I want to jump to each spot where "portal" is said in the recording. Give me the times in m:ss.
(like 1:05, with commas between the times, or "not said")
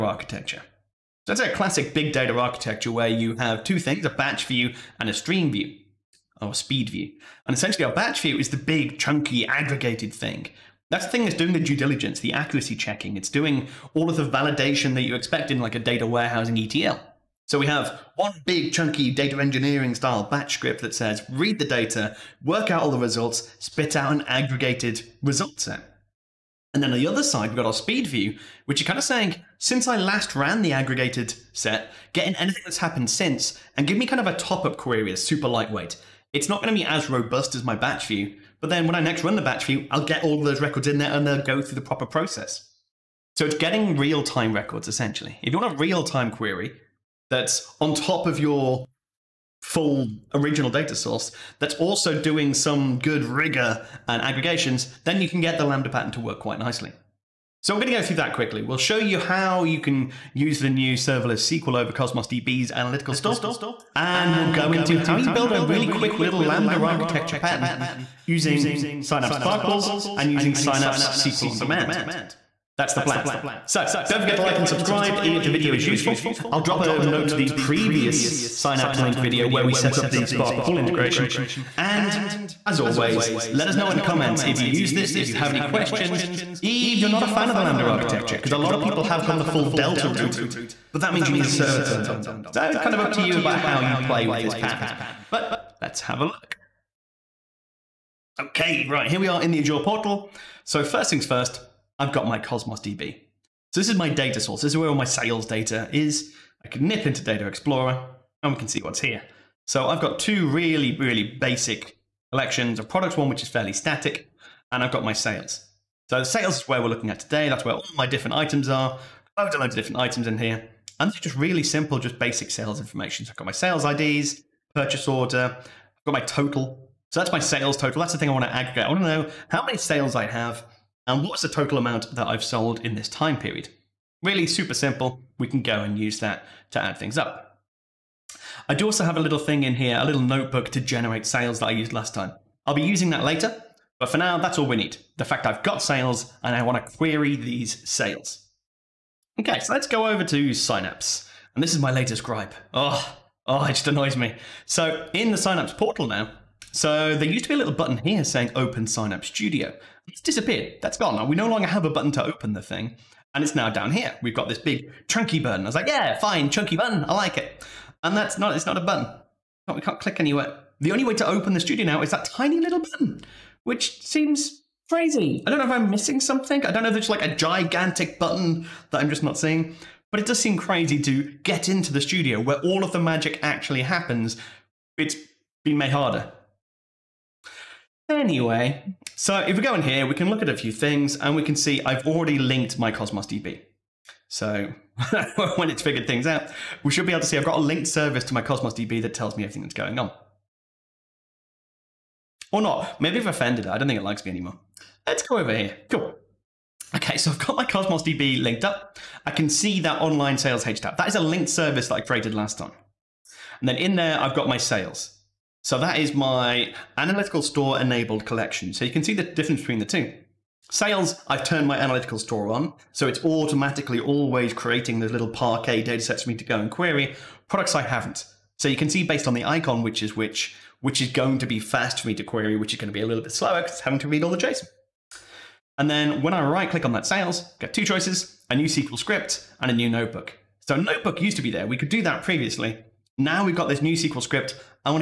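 1:39, 2:35.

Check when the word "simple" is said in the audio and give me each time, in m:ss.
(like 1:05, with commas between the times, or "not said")
2:01, 2:14.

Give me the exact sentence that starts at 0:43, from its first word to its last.
So it's getting real time records essentially.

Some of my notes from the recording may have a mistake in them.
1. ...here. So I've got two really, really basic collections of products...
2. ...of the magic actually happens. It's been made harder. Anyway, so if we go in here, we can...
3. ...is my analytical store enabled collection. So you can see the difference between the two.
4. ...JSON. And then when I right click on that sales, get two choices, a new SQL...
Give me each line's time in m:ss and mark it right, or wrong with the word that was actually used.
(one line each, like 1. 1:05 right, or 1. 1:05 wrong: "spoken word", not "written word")
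1. 1:49 right
2. 3:02 right
3. 3:35 right
4. 3:54 right.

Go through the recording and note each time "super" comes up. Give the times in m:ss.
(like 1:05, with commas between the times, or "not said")
0:35, 2:14.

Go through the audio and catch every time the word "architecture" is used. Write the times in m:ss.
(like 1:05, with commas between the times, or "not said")
0:02, 1:06, 1:27.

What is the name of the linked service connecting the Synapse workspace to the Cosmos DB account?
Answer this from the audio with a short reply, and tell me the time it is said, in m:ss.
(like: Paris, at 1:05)
online sales HTAP, at 3:30.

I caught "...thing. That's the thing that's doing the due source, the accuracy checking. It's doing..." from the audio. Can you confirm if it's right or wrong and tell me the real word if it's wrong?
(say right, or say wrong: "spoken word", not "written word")
wrong: "diligence", not "source".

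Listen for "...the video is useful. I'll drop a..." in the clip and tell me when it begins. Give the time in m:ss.
1:15.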